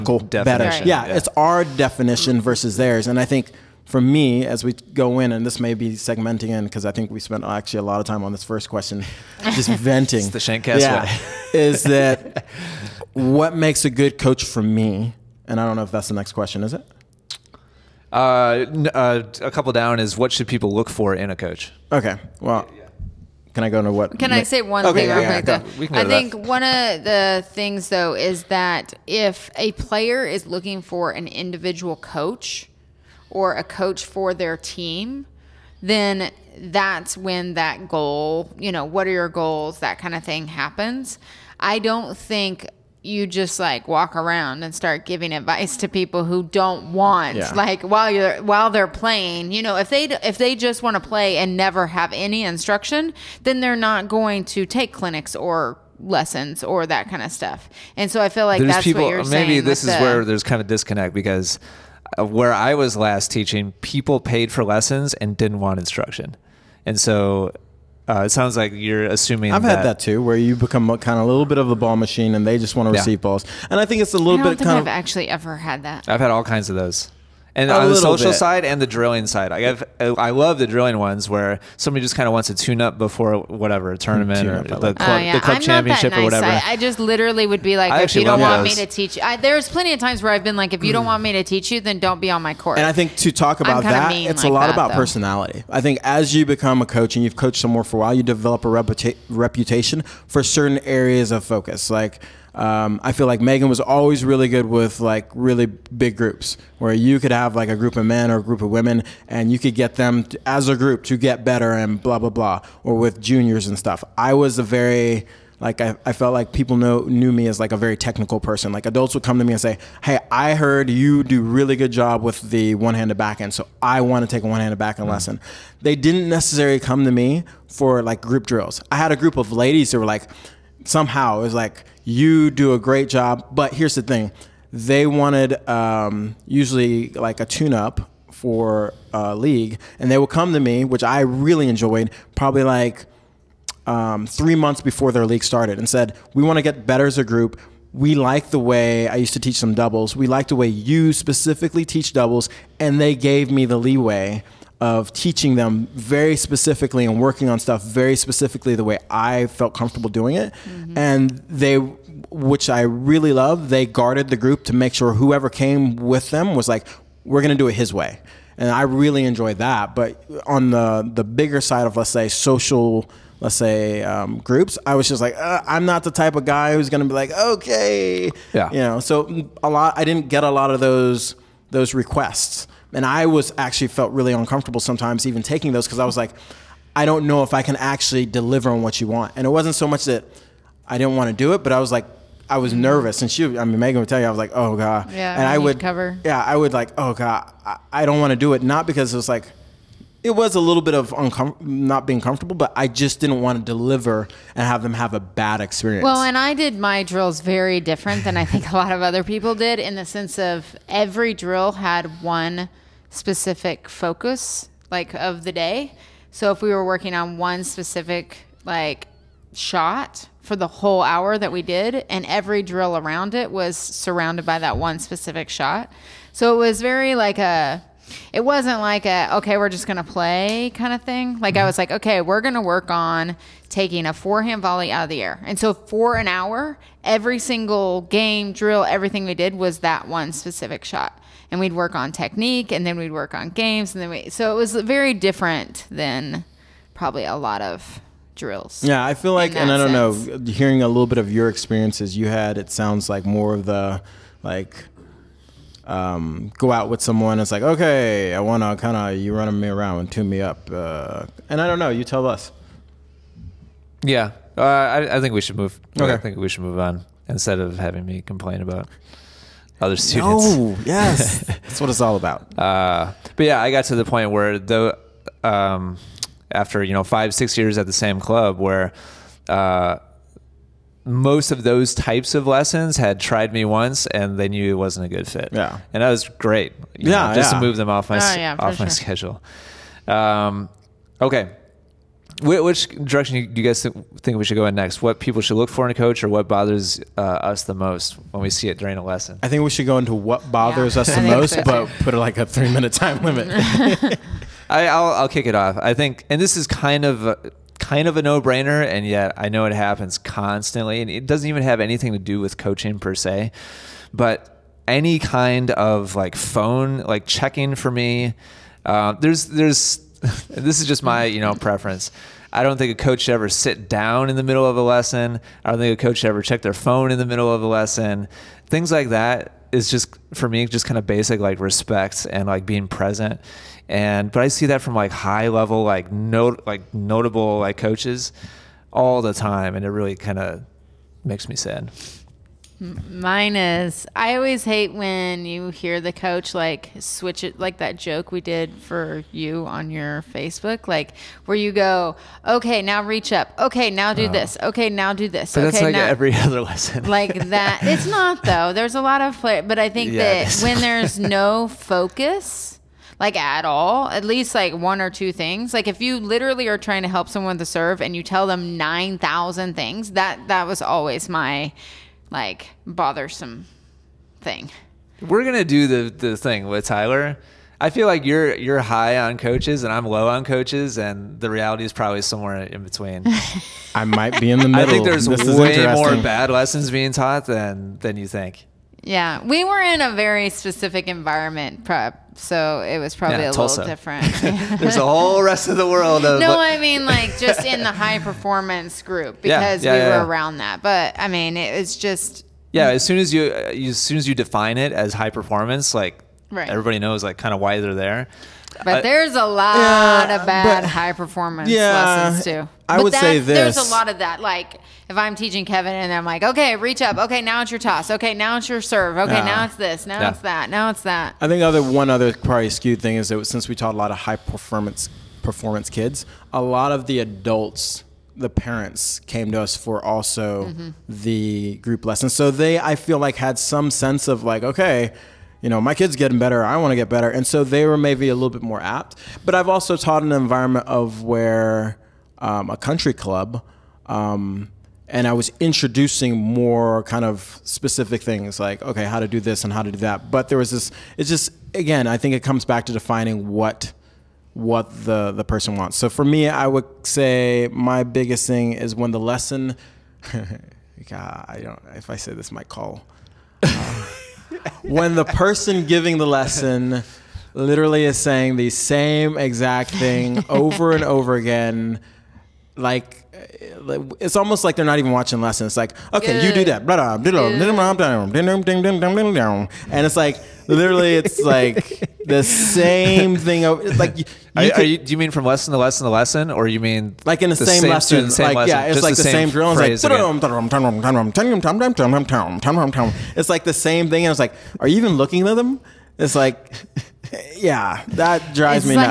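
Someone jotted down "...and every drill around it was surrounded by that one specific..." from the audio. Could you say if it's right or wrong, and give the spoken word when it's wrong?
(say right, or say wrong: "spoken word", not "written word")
right.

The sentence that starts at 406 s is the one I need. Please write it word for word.
everybody knows like kind of why they're there.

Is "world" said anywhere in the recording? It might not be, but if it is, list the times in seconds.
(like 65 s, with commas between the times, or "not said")
395 s.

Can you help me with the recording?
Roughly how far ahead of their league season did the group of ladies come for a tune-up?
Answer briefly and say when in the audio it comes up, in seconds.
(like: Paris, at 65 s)
3 months, at 144 s.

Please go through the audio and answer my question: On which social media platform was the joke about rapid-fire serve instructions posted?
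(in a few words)
Facebook.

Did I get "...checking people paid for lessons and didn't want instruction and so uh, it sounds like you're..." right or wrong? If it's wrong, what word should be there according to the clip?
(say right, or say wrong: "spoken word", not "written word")
wrong: "teaching", not "checking".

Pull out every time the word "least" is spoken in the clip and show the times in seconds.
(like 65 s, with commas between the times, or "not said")
364 s.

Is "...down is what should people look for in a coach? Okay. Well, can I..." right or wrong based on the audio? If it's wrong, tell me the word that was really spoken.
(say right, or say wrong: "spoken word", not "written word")
right.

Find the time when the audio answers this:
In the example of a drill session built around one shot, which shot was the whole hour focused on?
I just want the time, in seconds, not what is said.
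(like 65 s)
234 s.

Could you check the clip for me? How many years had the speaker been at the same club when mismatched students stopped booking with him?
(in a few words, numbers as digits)
5 or 6 years.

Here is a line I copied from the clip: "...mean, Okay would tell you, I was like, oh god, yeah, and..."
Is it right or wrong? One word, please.
wrong.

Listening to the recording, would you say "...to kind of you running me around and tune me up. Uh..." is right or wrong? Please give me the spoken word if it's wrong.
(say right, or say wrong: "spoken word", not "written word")
right.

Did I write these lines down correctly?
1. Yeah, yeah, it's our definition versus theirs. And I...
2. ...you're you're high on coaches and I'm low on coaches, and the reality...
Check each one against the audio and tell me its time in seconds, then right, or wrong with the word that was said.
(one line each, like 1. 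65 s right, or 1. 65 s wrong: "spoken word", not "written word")
1. 0 s right
2. 378 s right.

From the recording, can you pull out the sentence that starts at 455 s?
So for me, I would say my biggest thing is when the lesson.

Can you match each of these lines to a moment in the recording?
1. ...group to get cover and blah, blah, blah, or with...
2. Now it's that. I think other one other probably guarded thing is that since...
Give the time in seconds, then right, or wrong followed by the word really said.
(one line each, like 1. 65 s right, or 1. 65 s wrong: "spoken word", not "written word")
1. 110 s wrong: "better", not "cover"
2. 420 s wrong: "skewed", not "guarded".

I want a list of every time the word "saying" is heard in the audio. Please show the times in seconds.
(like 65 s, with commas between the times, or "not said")
59 s, 468 s.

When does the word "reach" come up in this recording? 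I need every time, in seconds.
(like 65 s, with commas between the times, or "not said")
353 s, 416 s.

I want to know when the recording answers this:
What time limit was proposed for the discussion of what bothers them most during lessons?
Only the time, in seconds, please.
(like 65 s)
302 s.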